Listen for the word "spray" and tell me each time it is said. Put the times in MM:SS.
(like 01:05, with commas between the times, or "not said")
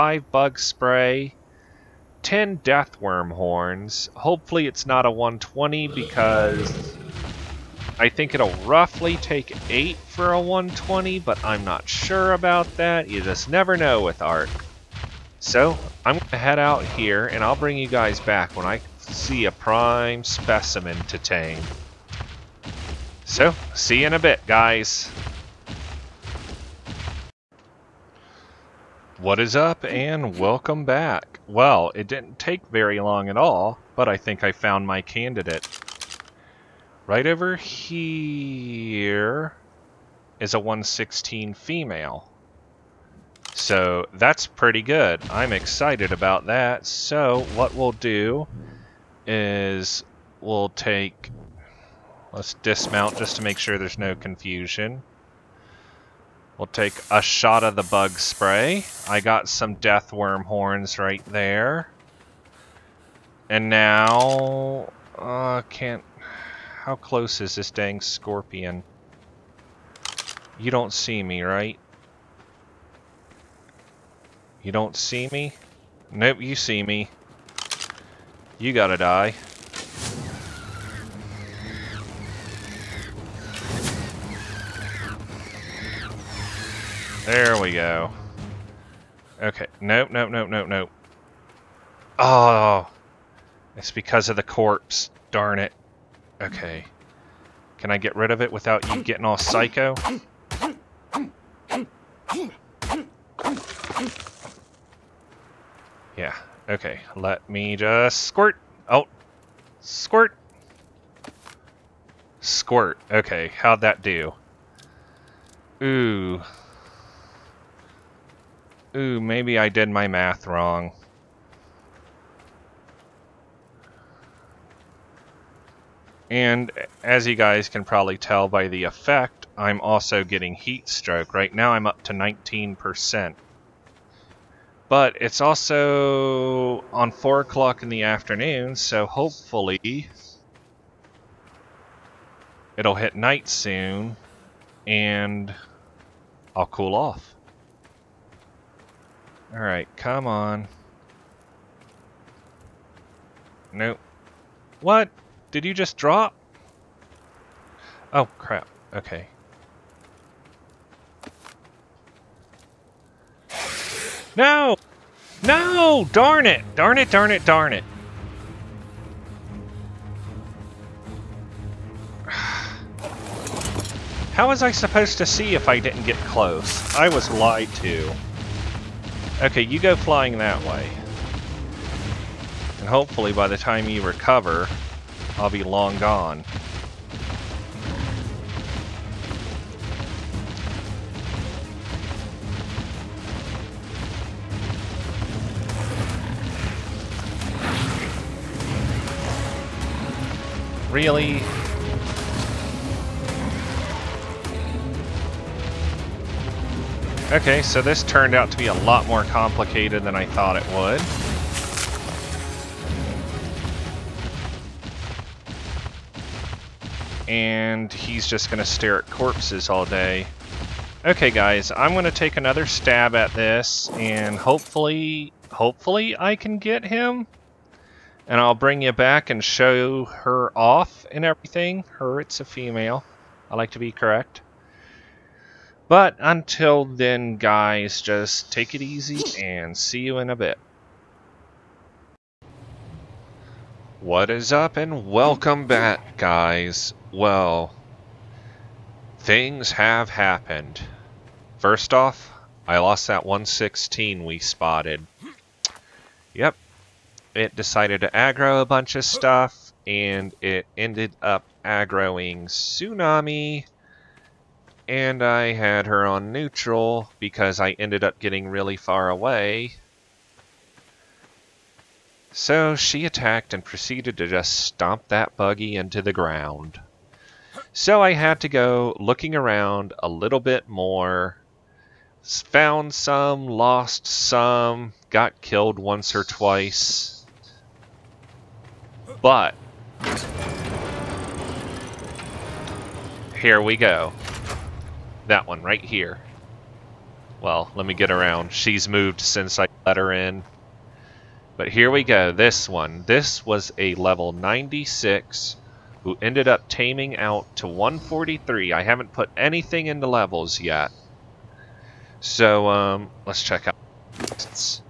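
00:00, 00:58.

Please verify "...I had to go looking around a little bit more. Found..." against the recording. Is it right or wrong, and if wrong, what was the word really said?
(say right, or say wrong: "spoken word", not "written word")
right.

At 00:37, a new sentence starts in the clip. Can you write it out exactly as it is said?
Right over here is a 116 female.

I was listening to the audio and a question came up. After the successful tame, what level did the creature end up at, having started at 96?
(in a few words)
143.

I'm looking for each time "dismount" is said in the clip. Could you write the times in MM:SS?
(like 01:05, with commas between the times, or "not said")
00:52.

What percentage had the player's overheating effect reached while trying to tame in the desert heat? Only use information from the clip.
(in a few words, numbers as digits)
19%.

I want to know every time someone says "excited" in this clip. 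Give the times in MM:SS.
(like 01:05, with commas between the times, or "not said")
00:45.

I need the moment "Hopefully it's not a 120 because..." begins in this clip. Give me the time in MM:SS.
00:04.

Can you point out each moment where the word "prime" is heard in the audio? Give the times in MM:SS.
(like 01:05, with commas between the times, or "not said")
00:19.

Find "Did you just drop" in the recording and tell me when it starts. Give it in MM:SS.
02:35.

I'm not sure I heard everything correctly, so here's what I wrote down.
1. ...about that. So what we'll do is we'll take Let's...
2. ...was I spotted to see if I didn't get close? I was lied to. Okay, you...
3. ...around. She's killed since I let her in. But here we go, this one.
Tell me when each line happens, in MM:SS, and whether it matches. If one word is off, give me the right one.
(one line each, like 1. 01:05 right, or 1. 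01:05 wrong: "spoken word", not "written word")
1. 00:46 right
2. 02:54 wrong: "supposed", not "spotted"
3. 04:58 wrong: "moved", not "killed".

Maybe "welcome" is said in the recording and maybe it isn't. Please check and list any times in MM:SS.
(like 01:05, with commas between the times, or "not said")
00:30, 04:05.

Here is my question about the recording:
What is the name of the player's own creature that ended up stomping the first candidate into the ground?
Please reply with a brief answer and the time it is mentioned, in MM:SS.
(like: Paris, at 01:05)
Tsunami, at 04:22.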